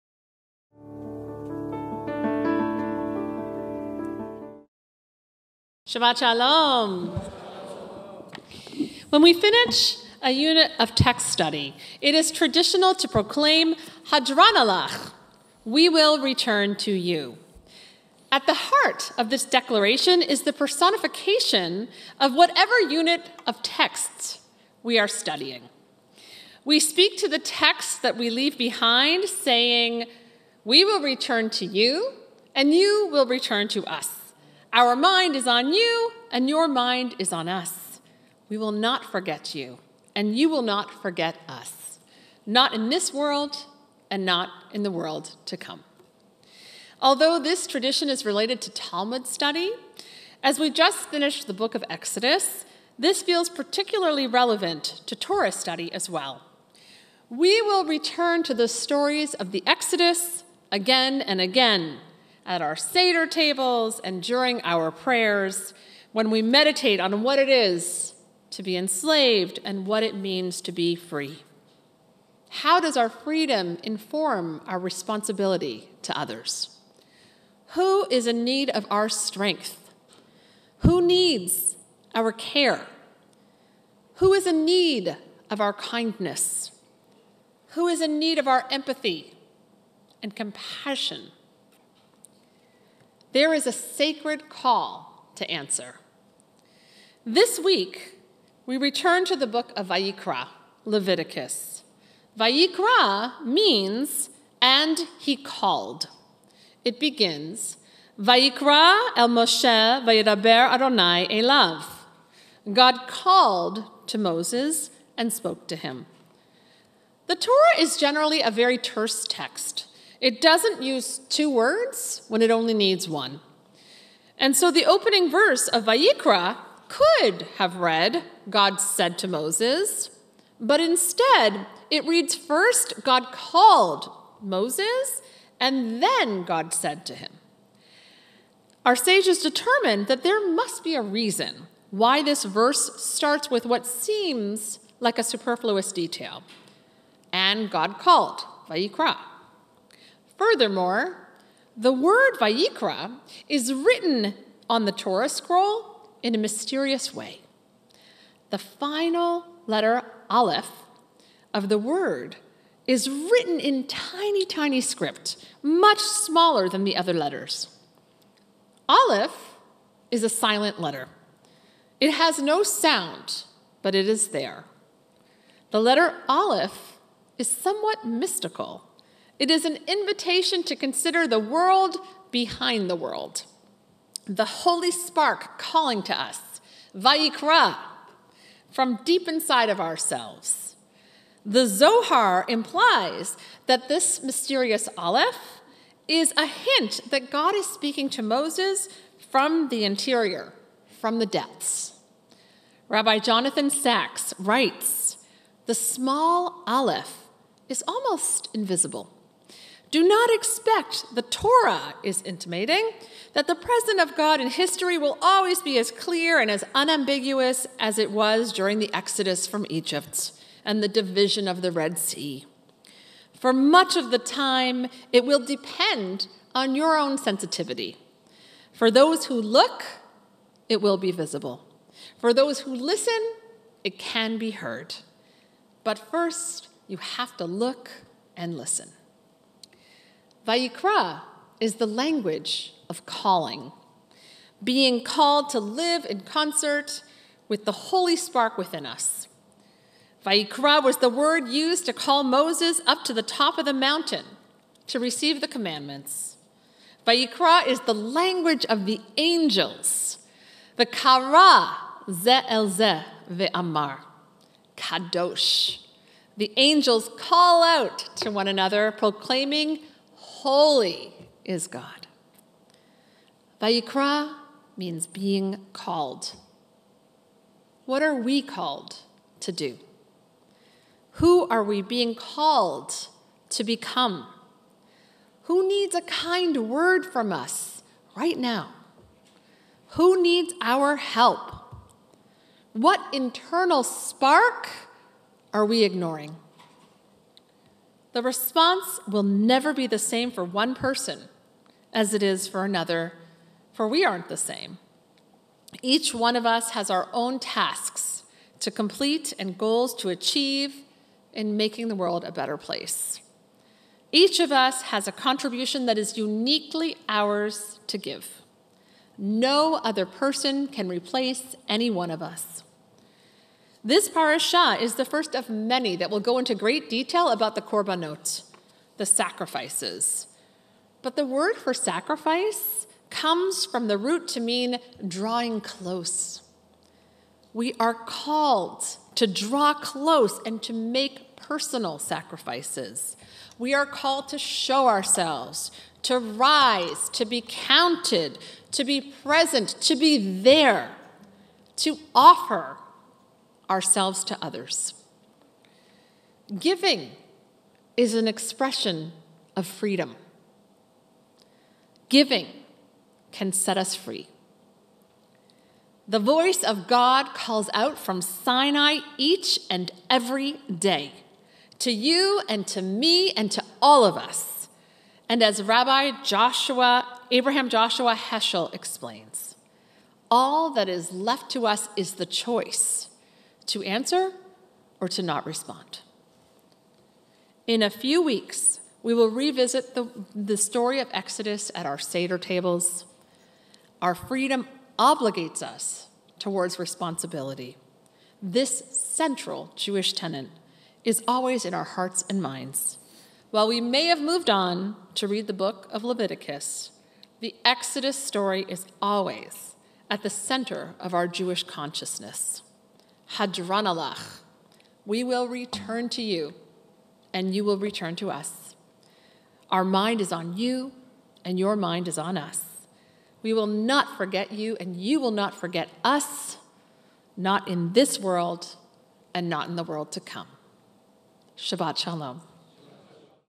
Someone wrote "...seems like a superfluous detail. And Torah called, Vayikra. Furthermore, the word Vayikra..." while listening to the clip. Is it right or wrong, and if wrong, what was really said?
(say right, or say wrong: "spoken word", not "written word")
wrong: "God", not "Torah".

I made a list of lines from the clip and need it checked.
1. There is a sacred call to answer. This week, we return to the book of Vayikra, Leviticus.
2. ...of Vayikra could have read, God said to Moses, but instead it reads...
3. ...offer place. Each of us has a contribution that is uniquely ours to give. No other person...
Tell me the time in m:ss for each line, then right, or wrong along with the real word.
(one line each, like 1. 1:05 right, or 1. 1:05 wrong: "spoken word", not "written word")
1. 1:33 right
2. 2:05 right
3. 5:12 wrong: "better", not "offer".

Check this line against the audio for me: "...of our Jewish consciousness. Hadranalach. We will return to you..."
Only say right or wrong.
right.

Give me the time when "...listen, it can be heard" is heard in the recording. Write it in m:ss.
3:52.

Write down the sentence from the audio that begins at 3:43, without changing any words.
For much of the time, it will depend on your own sensitivity.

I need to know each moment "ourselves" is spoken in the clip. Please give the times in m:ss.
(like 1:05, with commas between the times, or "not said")
3:09, 5:44, 5:53.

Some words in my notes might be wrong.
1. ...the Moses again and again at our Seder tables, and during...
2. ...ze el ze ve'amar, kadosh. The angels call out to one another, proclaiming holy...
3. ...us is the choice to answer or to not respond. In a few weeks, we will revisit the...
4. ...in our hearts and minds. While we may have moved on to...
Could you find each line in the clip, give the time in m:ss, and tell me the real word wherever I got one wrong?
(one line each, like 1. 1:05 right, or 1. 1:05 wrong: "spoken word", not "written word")
1. 0:59 wrong: "Exodus", not "Moses"
2. 4:22 right
3. 6:21 right
4. 6:41 right.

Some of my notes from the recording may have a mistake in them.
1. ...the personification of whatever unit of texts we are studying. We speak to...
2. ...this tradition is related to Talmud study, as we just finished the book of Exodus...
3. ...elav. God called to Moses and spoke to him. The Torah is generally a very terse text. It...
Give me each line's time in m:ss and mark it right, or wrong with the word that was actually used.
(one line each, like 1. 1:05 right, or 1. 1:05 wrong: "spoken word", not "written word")
1. 0:20 right
2. 0:47 right
3. 1:51 right.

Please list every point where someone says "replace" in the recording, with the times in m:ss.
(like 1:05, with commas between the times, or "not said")
5:20.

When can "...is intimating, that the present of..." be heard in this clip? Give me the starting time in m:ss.
3:32.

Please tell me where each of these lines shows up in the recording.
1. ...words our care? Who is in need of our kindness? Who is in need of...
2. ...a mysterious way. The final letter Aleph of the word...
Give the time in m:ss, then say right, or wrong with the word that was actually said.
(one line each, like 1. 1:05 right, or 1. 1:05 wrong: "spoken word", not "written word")
1. 1:21 wrong: "needs", not "words"
2. 2:36 right.